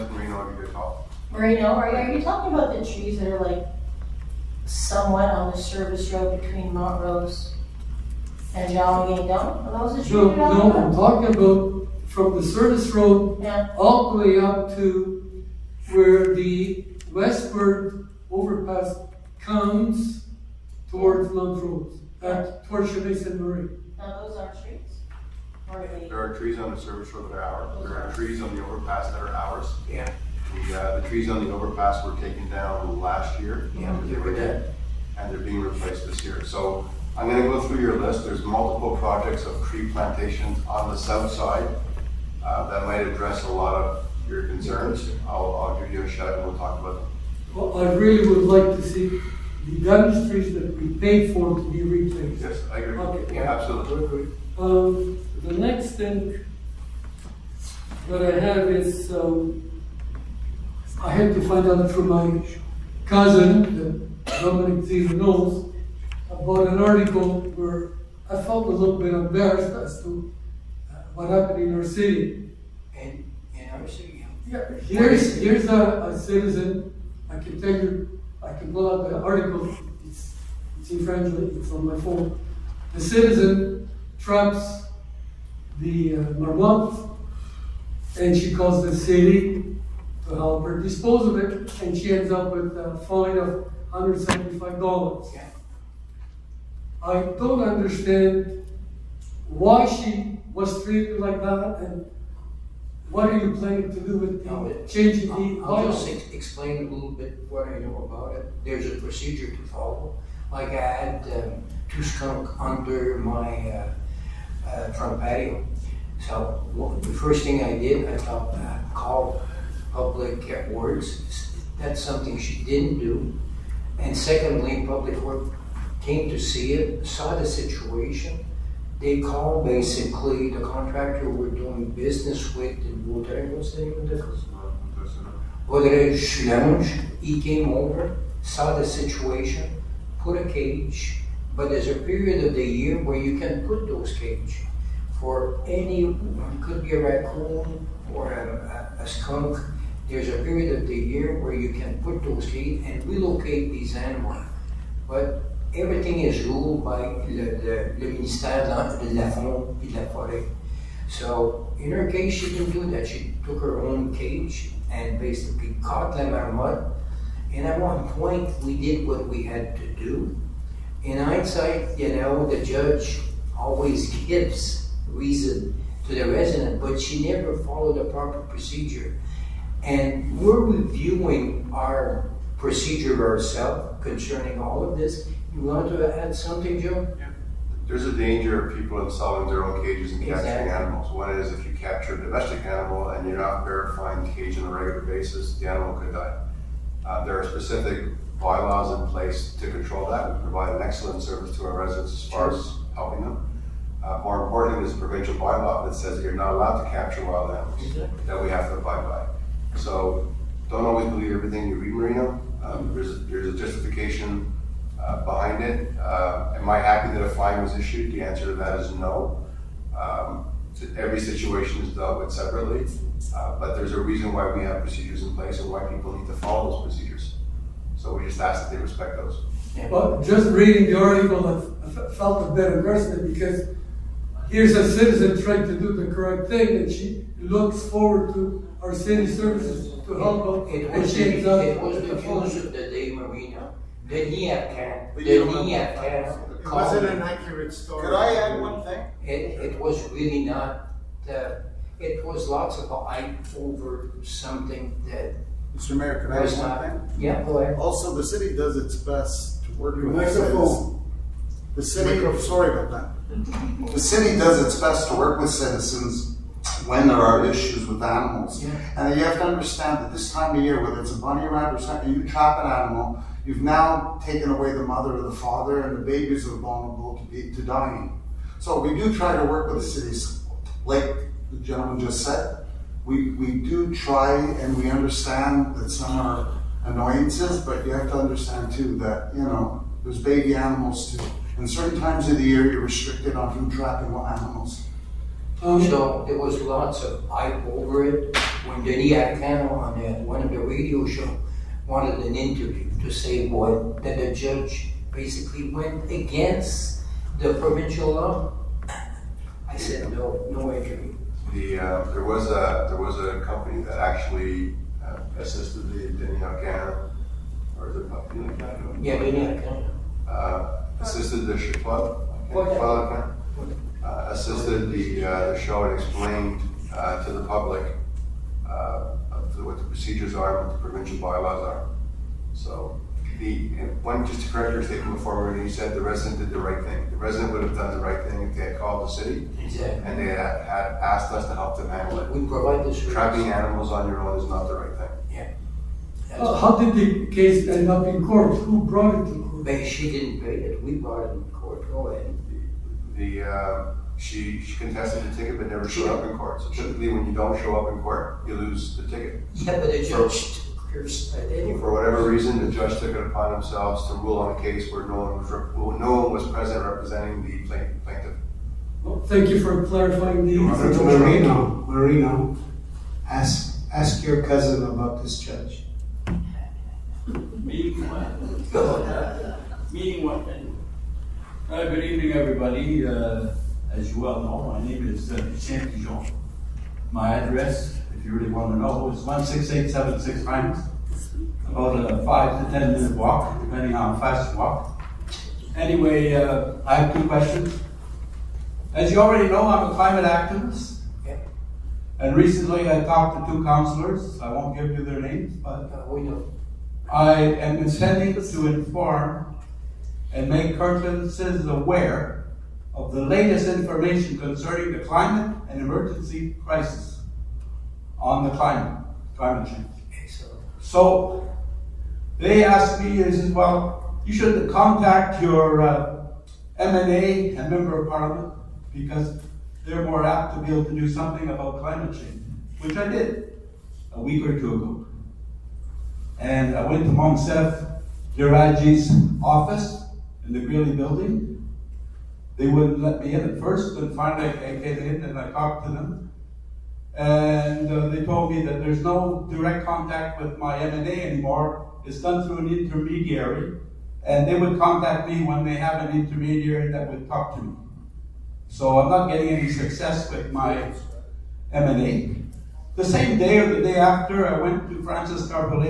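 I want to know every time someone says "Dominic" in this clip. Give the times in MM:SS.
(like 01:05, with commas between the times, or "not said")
01:04.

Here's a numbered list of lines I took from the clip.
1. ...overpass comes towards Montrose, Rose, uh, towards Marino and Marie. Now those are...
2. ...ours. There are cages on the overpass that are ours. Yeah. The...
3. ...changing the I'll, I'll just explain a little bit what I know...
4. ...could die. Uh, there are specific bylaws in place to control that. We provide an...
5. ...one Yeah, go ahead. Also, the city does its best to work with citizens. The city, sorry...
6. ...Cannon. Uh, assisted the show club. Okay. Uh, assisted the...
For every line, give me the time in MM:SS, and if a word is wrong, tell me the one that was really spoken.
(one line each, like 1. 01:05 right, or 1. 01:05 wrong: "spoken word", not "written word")
1. 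00:18 wrong: "Chavez", not "Marino"
2. 00:27 wrong: "trees", not "cages"
3. 01:44 right
4. 03:15 right
5. 04:16 right
6. 05:19 right.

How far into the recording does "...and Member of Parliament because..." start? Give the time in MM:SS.
07:07.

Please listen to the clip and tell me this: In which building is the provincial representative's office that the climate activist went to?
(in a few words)
Greeley building.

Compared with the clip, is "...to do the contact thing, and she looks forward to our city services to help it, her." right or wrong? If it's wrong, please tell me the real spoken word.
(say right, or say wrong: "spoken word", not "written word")
wrong: "correct", not "contact".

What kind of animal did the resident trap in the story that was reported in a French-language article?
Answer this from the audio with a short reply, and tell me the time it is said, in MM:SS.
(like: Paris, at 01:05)
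Marmot, at 01:26.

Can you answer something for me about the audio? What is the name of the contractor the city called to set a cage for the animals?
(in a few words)
Rodriguez.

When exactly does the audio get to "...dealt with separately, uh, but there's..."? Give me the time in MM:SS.
03:41.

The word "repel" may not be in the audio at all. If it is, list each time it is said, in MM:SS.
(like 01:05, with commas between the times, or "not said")
not said.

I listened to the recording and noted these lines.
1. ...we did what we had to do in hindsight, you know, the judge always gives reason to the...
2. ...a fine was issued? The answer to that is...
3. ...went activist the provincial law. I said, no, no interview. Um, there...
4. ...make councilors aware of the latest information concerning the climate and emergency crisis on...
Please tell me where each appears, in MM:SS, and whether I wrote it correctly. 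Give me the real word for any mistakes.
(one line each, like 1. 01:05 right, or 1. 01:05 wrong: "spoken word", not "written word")
1. 02:48 right
2. 03:37 right
3. 05:05 wrong: "against", not "activist"
4. 06:50 right.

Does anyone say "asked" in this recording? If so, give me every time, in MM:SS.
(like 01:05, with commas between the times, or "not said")
05:41, 07:02.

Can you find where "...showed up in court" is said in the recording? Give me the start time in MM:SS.
05:55.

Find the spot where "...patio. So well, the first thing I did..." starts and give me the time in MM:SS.
01:55.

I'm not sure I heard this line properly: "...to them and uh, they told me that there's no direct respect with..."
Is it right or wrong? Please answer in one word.
wrong.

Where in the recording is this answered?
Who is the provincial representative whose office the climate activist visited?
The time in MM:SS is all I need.
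07:17.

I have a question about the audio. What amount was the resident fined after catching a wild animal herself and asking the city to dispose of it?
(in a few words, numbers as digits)
$175.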